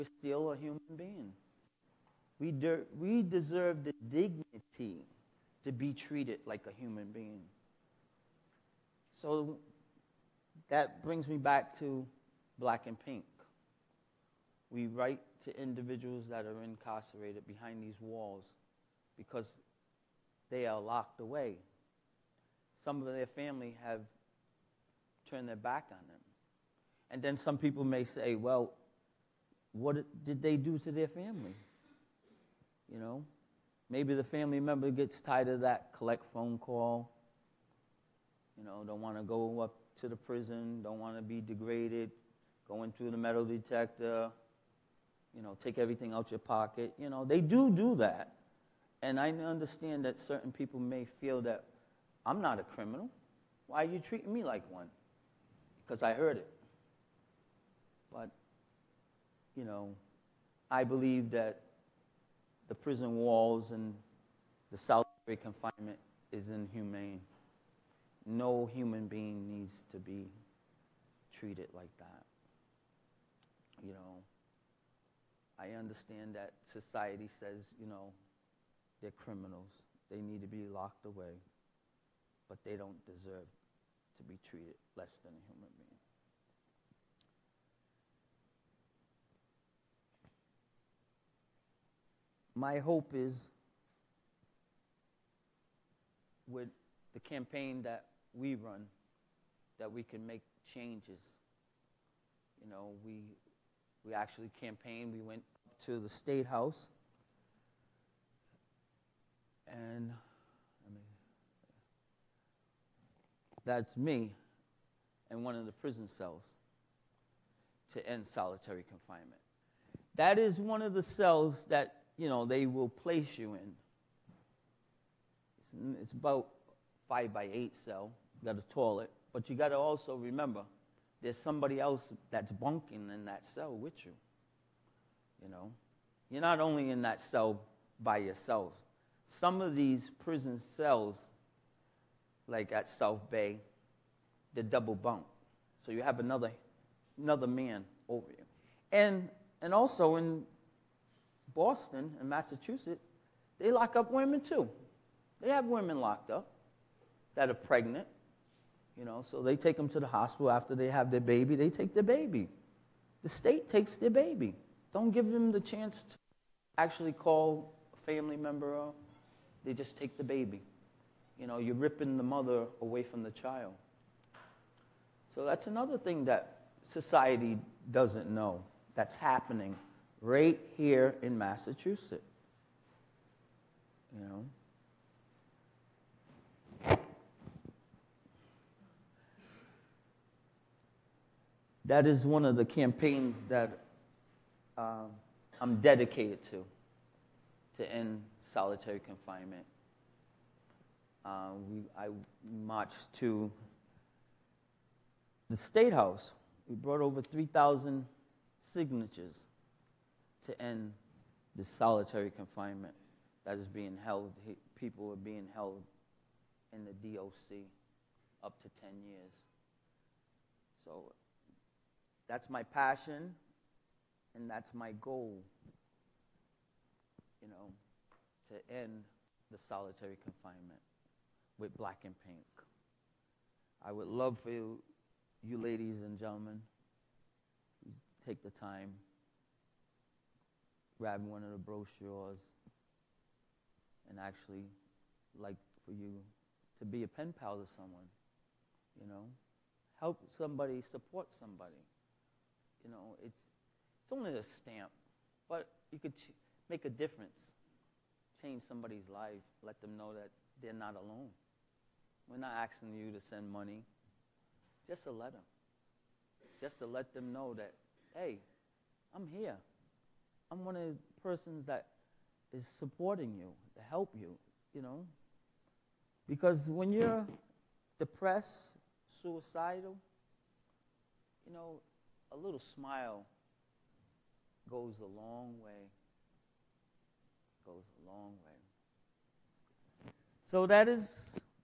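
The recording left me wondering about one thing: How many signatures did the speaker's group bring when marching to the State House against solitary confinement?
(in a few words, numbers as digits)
over 3,000.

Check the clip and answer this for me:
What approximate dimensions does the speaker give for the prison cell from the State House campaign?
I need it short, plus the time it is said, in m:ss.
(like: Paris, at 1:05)
5 by 8, at 2:07.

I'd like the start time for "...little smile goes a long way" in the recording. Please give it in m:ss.
4:42.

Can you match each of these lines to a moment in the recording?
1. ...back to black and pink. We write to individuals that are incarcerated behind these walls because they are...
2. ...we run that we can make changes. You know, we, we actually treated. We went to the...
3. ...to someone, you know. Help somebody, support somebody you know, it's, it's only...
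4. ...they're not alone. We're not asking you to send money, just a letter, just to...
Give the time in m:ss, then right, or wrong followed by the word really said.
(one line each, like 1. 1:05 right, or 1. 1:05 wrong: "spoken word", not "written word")
1. 0:11 right
2. 1:38 wrong: "campaigned", not "treated"
3. 4:07 right
4. 4:20 right.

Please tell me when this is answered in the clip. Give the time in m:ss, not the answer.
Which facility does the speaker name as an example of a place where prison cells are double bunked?
2:22.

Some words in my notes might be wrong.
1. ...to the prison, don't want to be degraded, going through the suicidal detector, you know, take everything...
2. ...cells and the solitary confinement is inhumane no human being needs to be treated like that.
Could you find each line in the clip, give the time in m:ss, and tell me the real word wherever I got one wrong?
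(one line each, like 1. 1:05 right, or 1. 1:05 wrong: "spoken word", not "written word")
1. 0:40 wrong: "metal", not "suicidal"
2. 1:03 wrong: "walls", not "cells".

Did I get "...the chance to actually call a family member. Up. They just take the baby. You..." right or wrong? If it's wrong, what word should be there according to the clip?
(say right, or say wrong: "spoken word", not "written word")
right.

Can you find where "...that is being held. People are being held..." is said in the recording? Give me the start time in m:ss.
3:33.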